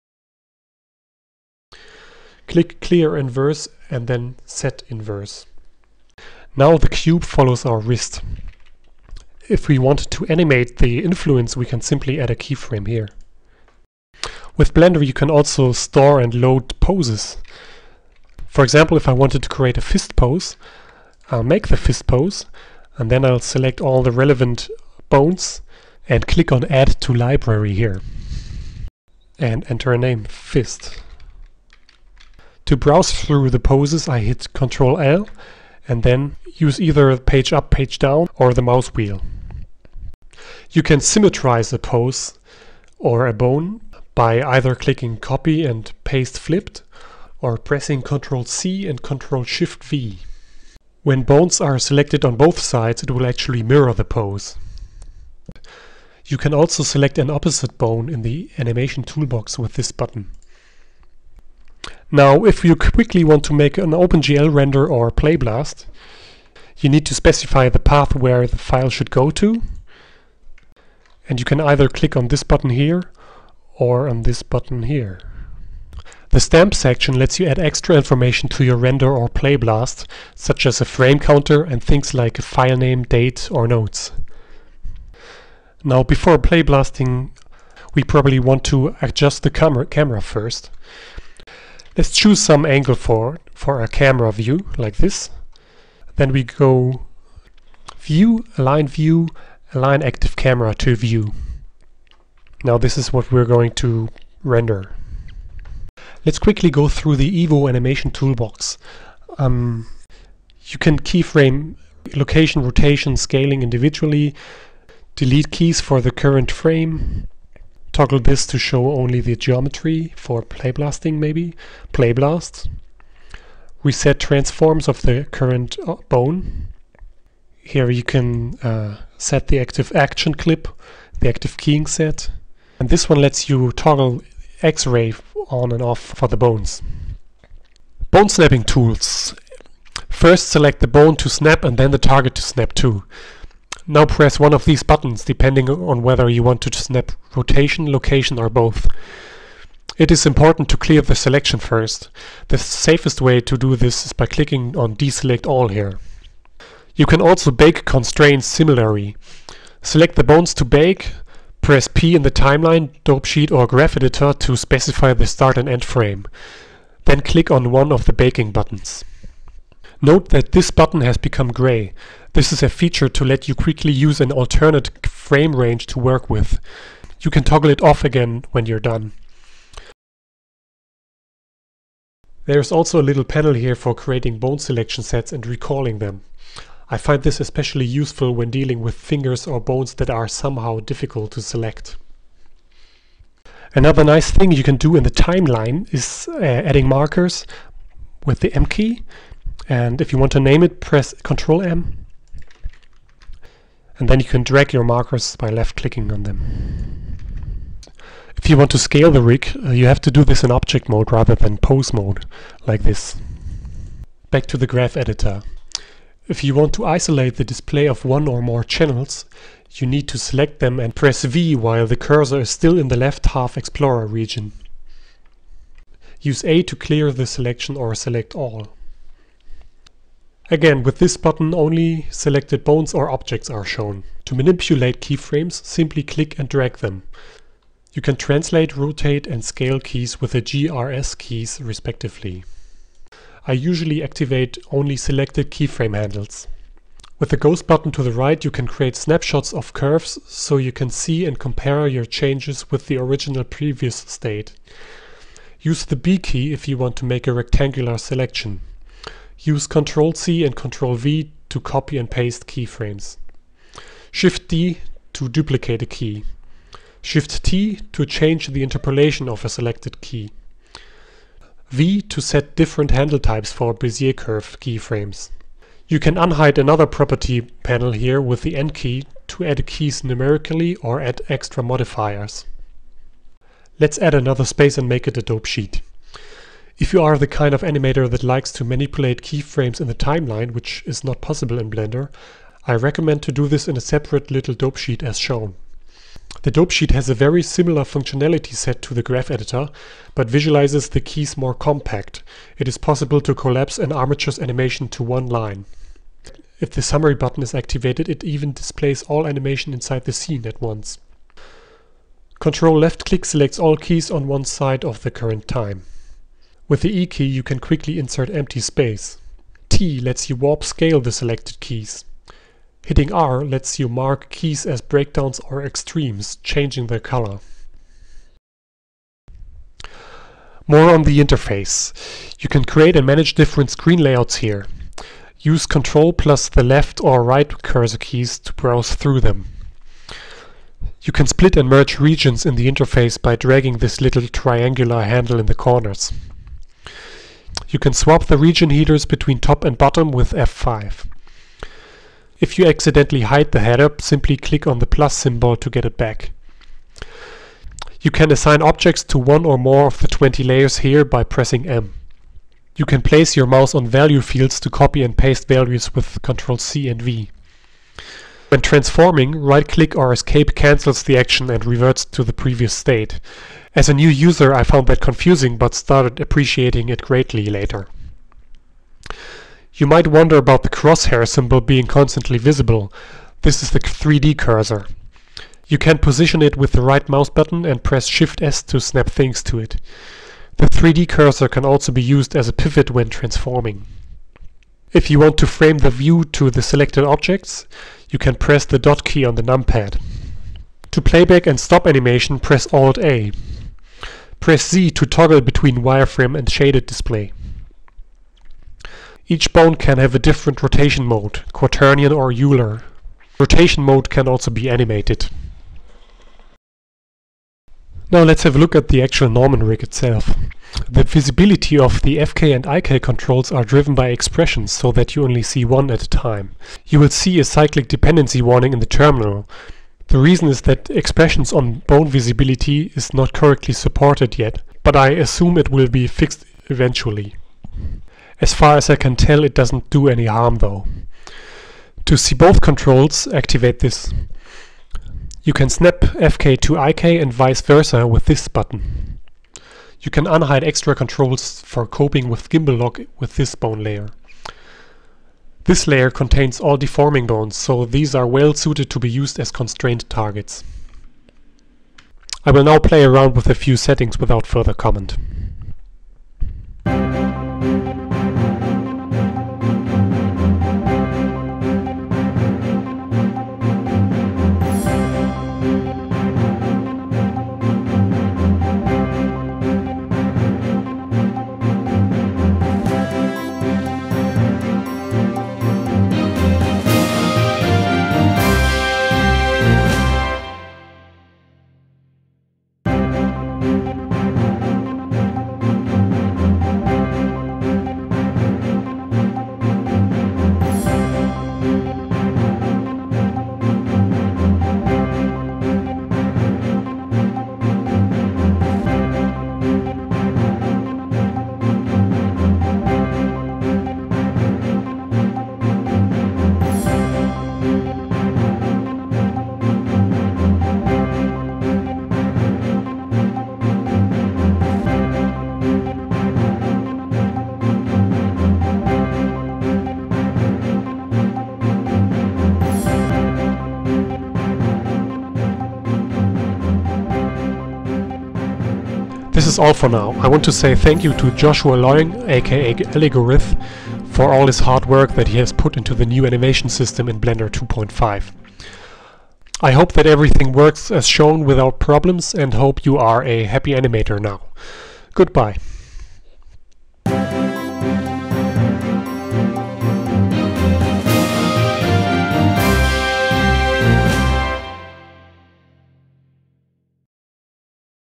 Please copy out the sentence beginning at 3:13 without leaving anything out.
Another nice thing you can do in the timeline is uh, adding markers with the M key.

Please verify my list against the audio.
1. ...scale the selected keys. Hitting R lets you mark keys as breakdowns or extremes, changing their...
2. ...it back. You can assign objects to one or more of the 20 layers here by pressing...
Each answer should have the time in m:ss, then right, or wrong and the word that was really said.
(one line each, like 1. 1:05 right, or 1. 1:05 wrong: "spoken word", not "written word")
1. 5:20 right
2. 5:55 right.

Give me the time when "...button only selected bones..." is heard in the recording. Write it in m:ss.
3:51.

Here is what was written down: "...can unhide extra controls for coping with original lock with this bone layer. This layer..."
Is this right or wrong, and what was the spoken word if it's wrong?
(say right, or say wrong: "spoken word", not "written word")
wrong: "gimbal", not "original".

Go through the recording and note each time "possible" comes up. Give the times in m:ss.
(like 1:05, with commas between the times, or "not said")
4:51, 5:02.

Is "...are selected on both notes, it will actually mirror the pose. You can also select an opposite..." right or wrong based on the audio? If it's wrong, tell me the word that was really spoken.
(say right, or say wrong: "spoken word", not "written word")
wrong: "sides", not "notes".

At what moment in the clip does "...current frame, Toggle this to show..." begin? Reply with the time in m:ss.
1:56.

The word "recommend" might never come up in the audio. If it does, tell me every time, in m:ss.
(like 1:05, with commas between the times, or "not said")
4:52.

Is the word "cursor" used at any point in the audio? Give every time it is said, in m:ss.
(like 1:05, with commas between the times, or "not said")
3:41, 5:37, 6:24, 6:31.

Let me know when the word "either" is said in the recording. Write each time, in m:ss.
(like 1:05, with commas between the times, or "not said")
0:36, 0:44, 1:11.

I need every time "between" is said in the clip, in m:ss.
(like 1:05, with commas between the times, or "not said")
5:49, 6:45.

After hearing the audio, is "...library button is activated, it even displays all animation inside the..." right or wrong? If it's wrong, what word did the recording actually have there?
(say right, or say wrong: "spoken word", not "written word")
wrong: "summary", not "library".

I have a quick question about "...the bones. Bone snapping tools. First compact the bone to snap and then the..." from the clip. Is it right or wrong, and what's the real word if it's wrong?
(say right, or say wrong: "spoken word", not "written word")
wrong: "select", not "compact".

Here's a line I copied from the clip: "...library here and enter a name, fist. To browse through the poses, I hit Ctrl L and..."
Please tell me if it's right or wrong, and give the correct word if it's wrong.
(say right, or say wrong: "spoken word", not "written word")
right.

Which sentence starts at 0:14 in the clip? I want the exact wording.
With Blender you can also store and load poses.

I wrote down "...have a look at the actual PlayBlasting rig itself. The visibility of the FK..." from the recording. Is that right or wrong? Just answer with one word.
wrong.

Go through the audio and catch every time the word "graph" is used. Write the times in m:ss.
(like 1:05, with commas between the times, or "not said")
2:43, 3:34, 4:59.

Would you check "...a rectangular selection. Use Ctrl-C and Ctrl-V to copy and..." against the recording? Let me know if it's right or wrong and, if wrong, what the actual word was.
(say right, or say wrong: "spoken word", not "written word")
right.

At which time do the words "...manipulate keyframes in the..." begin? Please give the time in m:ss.
4:48.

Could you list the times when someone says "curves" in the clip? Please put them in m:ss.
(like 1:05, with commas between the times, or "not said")
4:09, 4:34.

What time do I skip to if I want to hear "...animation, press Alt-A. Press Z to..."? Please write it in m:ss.
6:41.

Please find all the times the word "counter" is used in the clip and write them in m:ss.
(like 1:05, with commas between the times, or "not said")
1:21.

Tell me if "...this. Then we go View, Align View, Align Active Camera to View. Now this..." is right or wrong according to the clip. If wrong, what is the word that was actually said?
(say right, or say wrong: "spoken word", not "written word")
right.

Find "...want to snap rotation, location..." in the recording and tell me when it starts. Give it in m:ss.
2:26.